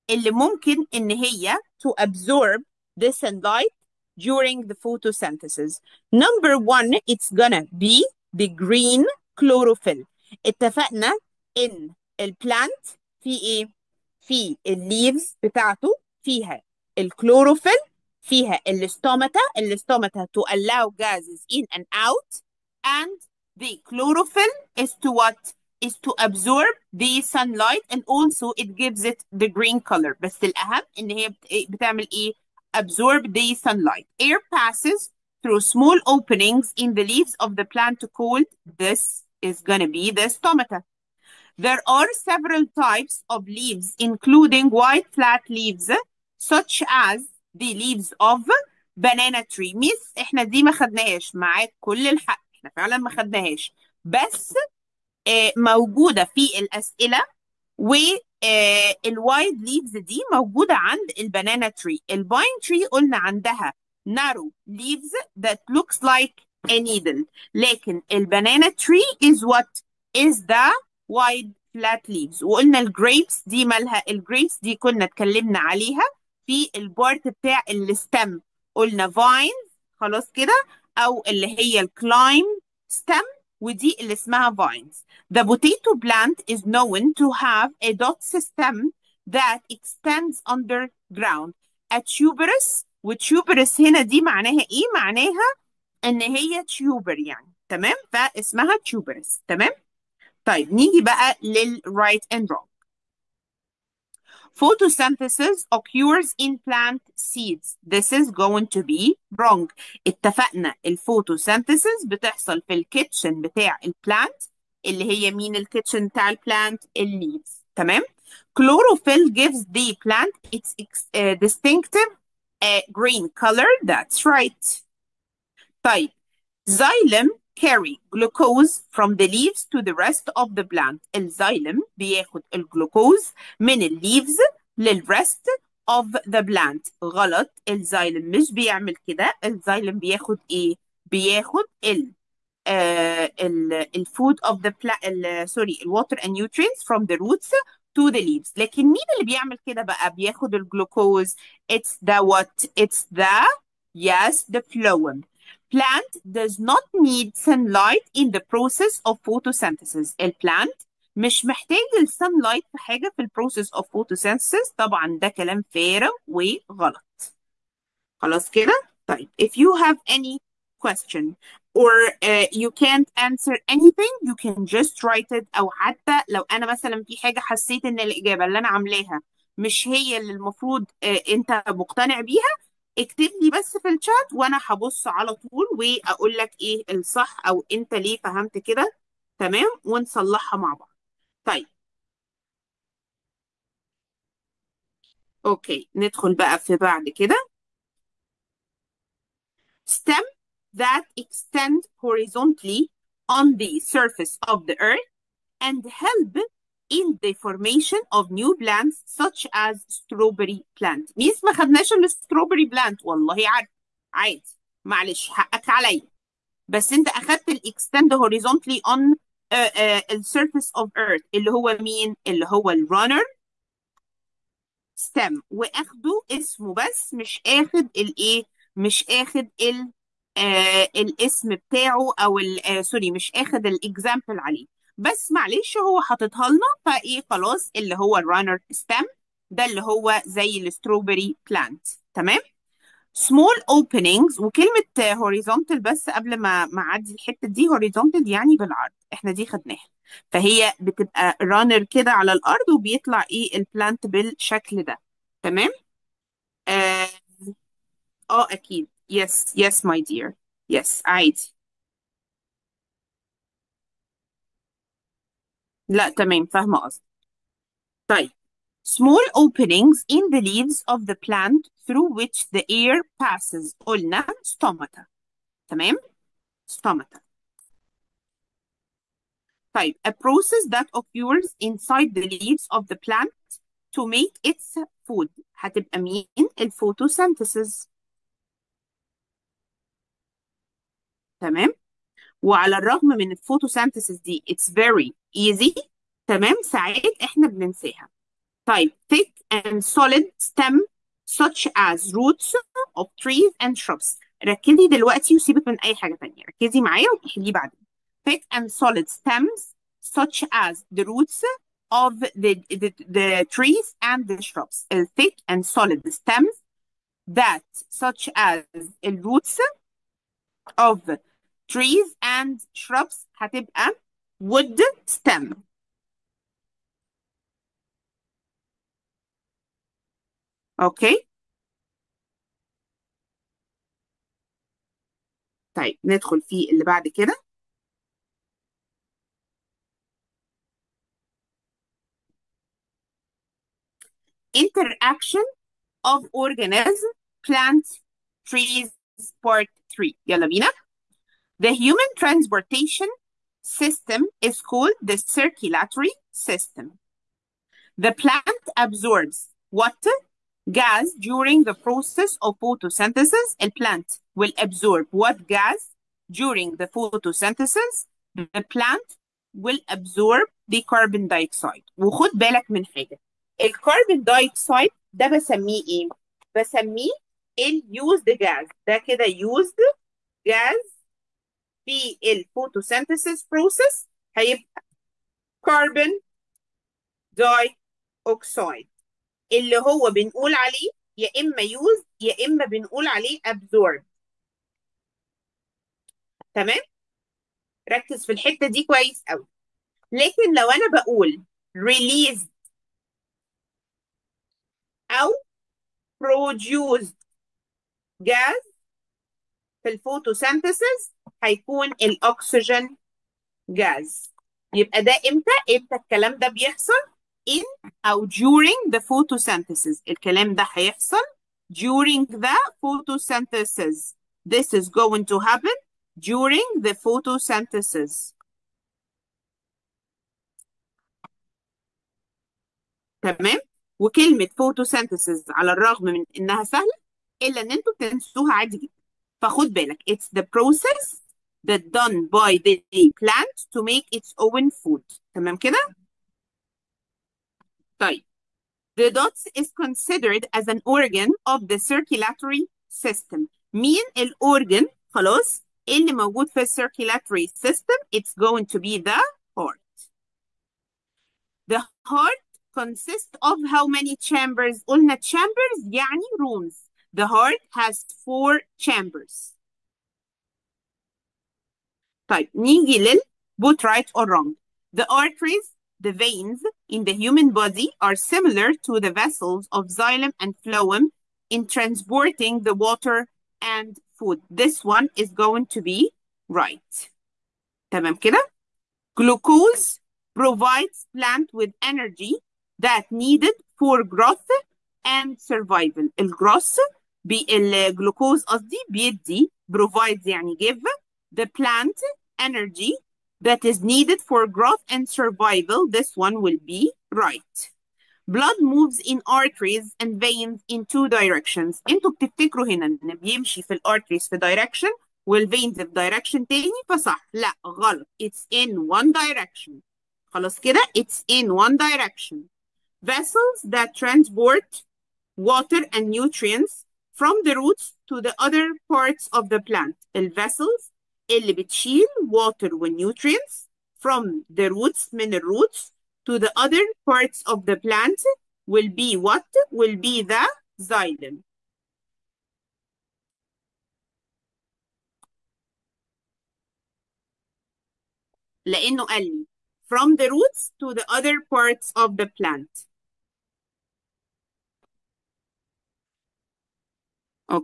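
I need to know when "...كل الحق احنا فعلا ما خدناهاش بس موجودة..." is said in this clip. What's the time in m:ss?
0:51.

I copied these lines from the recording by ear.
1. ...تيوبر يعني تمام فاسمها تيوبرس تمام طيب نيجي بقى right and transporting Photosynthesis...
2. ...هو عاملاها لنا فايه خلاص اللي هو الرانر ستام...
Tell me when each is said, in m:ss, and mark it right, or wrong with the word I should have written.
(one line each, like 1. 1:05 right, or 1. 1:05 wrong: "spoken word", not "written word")
1. 1:36 wrong: "wrong", not "transporting"
2. 3:55 wrong: "حاططها", not "عاملاها".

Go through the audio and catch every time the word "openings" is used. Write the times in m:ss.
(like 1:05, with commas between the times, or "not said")
0:36, 4:03, 4:29.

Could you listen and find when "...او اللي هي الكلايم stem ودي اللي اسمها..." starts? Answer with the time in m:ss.
1:20.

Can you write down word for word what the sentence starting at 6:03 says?
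A plant will absorb what gas during the photosynthesis?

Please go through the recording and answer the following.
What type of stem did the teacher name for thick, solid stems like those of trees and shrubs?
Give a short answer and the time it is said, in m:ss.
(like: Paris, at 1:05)
Wood stem, at 5:24.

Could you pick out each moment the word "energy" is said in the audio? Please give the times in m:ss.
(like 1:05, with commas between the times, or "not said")
8:11, 8:22.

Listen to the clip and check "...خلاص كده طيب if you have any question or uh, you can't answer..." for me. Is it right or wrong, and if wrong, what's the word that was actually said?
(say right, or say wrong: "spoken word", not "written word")
right.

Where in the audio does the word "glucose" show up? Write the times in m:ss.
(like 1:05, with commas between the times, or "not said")
2:08, 8:09.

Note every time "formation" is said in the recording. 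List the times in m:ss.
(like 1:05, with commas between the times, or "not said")
3:27.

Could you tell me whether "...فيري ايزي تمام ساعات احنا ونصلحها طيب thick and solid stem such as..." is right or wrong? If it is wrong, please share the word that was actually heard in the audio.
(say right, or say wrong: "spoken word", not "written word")
wrong: "بننساها", not "ونصلحها".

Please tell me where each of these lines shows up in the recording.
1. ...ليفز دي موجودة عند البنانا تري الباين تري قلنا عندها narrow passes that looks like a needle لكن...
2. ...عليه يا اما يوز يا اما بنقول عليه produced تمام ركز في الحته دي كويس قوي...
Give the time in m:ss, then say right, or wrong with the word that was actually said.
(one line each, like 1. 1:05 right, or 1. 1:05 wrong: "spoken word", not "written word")
1. 0:59 wrong: "leaves", not "passes"
2. 6:30 wrong: "absorbed", not "produced".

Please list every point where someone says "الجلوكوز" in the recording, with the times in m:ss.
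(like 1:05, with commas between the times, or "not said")
2:12, 2:30, 8:17.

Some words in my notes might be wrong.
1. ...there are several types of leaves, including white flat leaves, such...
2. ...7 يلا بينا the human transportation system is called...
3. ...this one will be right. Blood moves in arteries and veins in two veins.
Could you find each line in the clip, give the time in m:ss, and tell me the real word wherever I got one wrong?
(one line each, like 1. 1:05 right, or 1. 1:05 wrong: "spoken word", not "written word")
1. 0:41 right
2. 5:49 wrong: "3", not "7"
3. 8:25 wrong: "directions", not "veins".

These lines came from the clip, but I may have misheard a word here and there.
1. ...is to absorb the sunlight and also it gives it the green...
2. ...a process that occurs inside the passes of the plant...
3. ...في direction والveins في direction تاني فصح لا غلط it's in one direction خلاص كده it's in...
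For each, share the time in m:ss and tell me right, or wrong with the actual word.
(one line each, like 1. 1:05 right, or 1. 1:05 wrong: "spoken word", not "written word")
1. 0:25 right
2. 4:40 wrong: "leaves", not "passes"
3. 8:34 right.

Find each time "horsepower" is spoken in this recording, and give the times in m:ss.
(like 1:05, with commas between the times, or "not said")
not said.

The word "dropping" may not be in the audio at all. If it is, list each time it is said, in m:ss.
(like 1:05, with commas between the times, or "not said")
not said.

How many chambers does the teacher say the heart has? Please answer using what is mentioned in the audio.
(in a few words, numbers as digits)
4.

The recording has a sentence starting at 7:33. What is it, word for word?
مين organ خلاص اللي موجود في circulatory system it's going to be the heart.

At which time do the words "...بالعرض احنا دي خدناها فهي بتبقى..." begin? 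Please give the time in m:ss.
4:08.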